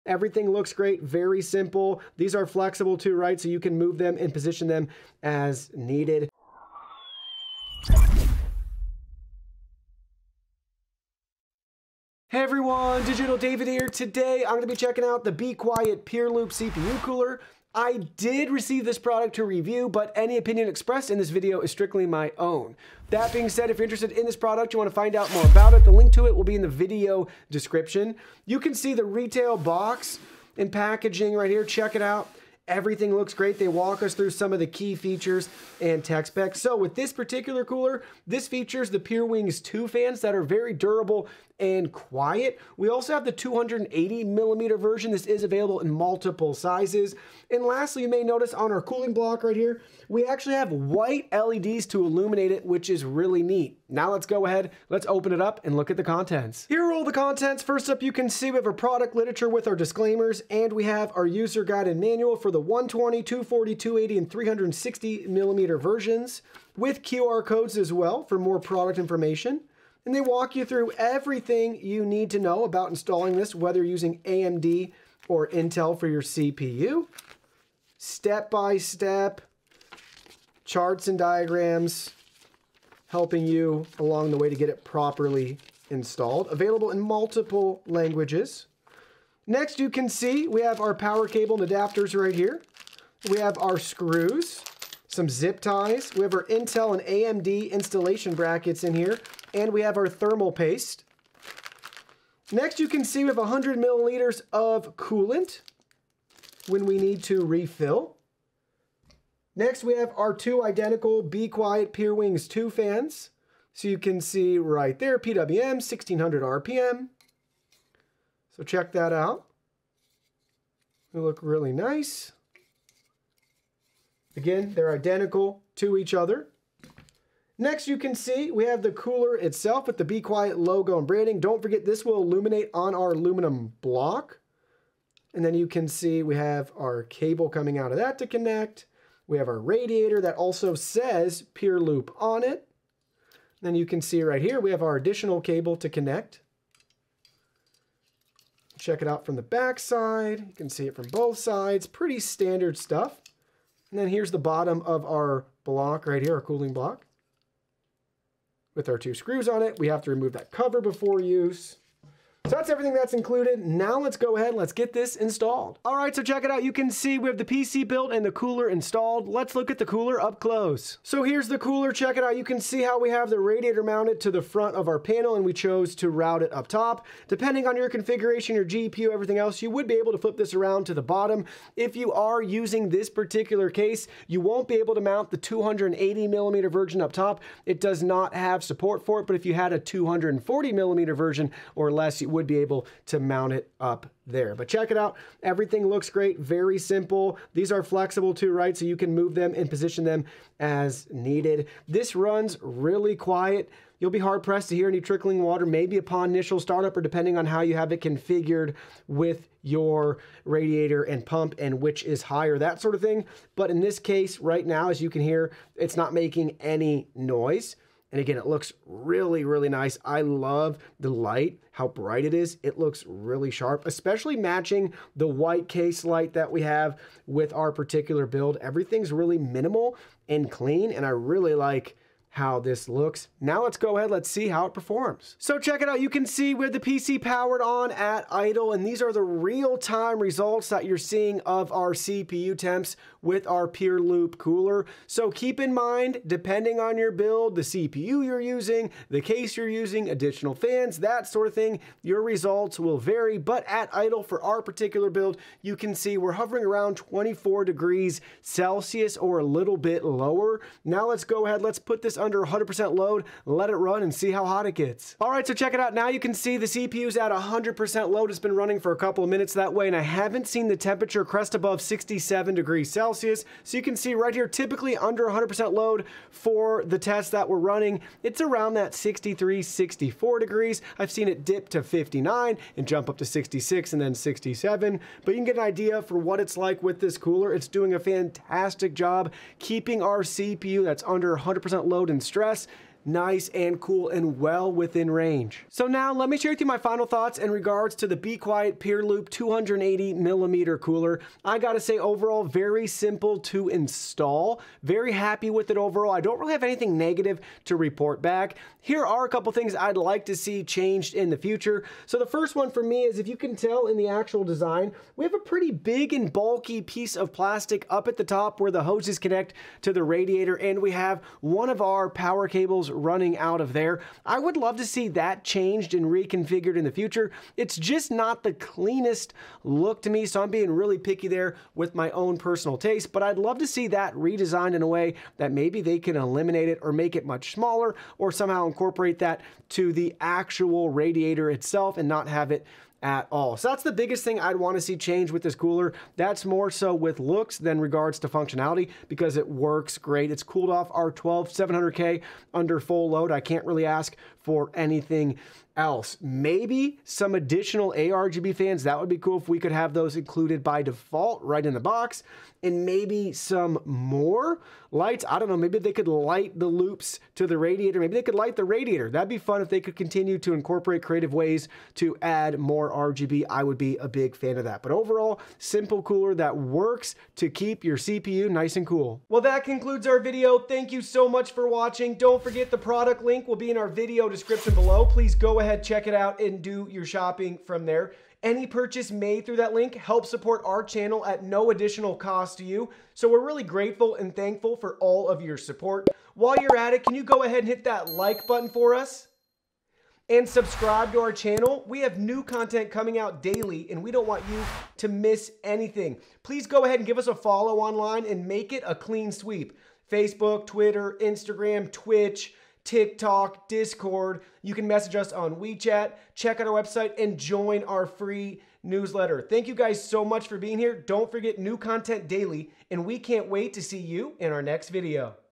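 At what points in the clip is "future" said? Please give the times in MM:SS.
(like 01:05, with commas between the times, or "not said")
05:11, 05:26.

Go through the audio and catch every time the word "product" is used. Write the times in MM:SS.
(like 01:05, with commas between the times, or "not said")
00:18, 00:24, 00:58, 01:08, 06:22.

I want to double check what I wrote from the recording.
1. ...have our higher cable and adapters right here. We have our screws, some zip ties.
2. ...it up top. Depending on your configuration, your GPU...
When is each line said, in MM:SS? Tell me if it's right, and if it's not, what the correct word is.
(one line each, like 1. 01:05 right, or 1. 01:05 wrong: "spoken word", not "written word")
1. 01:30 wrong: "power", not "higher"
2. 02:56 right.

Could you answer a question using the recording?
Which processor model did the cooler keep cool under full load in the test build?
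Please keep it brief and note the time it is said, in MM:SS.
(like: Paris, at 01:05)
12700K, at 05:51.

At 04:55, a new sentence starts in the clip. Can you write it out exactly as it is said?
So now let me share with you my final thoughts in regards to the Be Quiet Pure Loop 280 millimeter cooler.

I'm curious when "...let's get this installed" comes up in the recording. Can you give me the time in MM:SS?
02:44.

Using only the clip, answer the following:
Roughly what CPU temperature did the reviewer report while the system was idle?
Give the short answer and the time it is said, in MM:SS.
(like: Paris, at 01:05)
24 degrees Celsius, at 04:16.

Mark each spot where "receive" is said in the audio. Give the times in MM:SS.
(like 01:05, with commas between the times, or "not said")
00:18.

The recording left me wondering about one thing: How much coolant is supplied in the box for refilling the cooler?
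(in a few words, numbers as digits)
100 milliliters.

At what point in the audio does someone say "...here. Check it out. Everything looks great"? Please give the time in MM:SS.
00:31.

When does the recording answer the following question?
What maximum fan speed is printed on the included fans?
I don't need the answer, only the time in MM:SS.
01:55.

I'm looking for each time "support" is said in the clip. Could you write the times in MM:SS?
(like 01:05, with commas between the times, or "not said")
03:08, 06:30, 06:35.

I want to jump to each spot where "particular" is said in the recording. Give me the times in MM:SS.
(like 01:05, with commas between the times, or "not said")
00:37, 03:03, 03:47, 04:14.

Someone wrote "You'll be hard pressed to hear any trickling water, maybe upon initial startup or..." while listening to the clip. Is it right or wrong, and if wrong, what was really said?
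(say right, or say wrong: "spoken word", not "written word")
right.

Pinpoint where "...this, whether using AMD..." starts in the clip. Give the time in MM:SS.
01:13.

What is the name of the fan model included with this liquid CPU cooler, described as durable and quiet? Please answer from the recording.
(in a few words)
Pure Wings 2.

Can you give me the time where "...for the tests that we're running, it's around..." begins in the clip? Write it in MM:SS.
04:36.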